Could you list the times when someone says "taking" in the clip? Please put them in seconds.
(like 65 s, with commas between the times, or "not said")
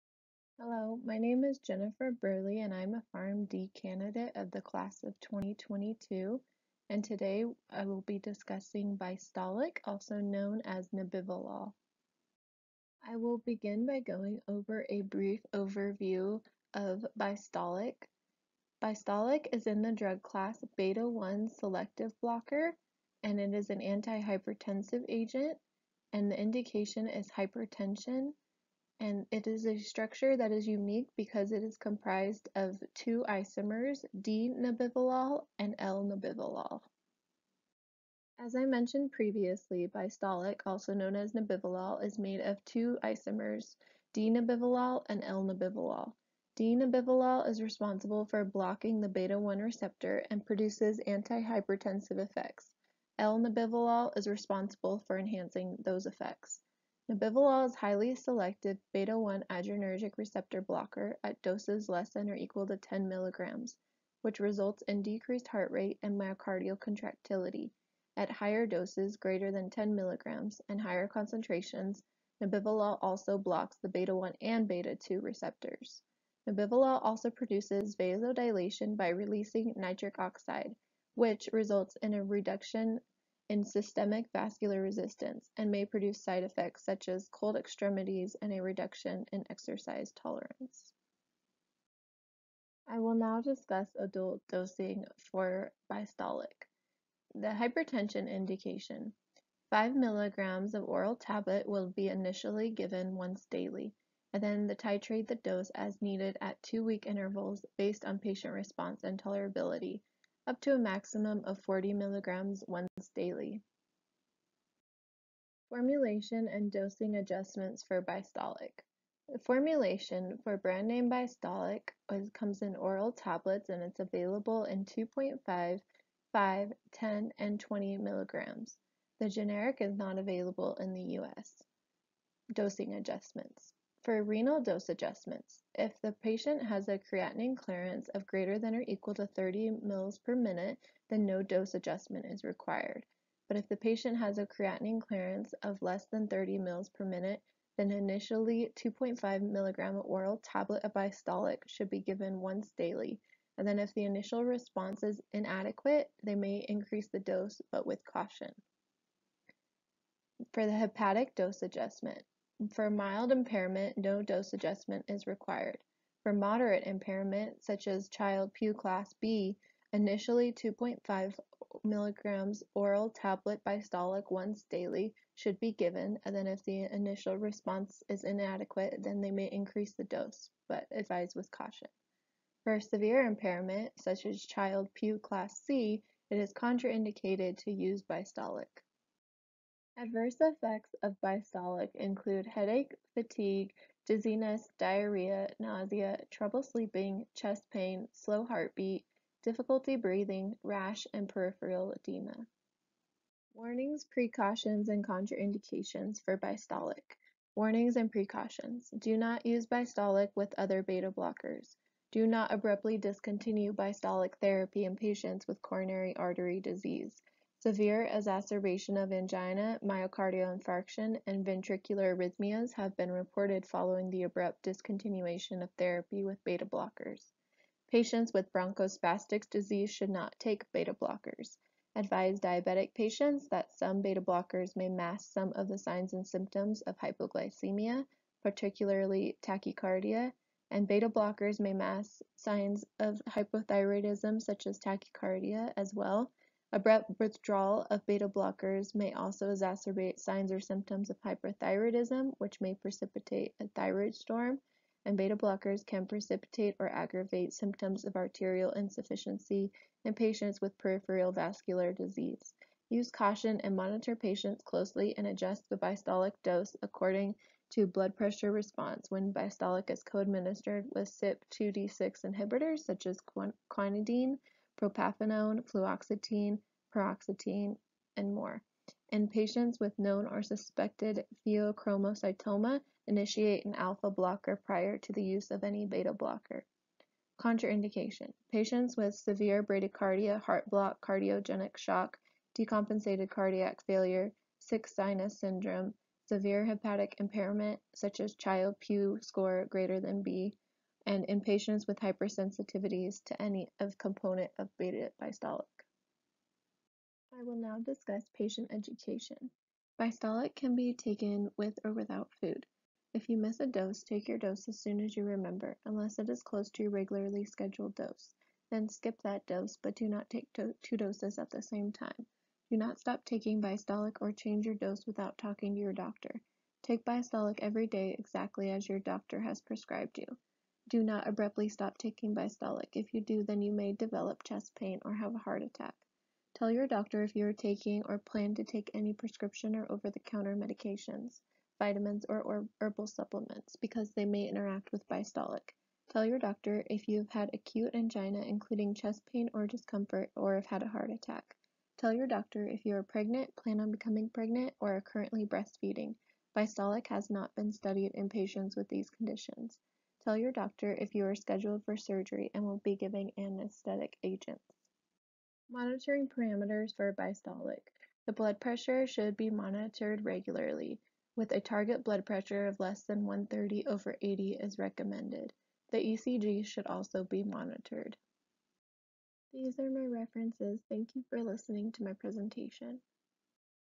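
323 s, 331 s, 337 s.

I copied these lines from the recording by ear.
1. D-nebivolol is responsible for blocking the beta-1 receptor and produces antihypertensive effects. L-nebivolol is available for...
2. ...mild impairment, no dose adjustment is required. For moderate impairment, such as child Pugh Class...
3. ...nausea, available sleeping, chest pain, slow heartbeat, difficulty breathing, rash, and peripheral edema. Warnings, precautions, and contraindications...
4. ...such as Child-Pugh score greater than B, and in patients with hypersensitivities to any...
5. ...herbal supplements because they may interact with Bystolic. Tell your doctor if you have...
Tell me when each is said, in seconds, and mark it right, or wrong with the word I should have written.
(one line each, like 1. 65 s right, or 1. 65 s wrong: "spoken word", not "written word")
1. 46 s wrong: "responsible", not "available"
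2. 162 s right
3. 195 s wrong: "trouble", not "available"
4. 297 s right
5. 342 s right.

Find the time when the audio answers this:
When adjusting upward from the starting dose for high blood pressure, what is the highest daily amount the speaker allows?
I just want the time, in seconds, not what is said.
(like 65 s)
111 s.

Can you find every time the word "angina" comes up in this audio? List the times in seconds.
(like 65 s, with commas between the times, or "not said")
219 s, 347 s.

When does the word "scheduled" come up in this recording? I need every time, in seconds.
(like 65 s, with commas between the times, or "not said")
317 s, 361 s.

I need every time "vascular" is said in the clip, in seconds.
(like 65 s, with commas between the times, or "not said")
84 s, 261 s.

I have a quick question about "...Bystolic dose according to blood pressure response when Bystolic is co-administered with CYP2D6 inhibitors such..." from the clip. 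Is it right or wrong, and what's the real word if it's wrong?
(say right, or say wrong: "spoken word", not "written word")
right.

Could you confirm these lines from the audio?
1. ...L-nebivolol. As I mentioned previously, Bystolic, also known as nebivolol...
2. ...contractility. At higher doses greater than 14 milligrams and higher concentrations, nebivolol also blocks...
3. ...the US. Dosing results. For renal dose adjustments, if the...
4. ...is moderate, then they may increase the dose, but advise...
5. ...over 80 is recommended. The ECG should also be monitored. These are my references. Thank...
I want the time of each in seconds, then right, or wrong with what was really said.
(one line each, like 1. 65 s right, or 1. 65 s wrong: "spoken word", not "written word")
1. 35 s right
2. 66 s wrong: "10", not "14"
3. 130 s wrong: "adjustments", not "results"
4. 178 s wrong: "inadequate", not "moderate"
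5. 373 s right.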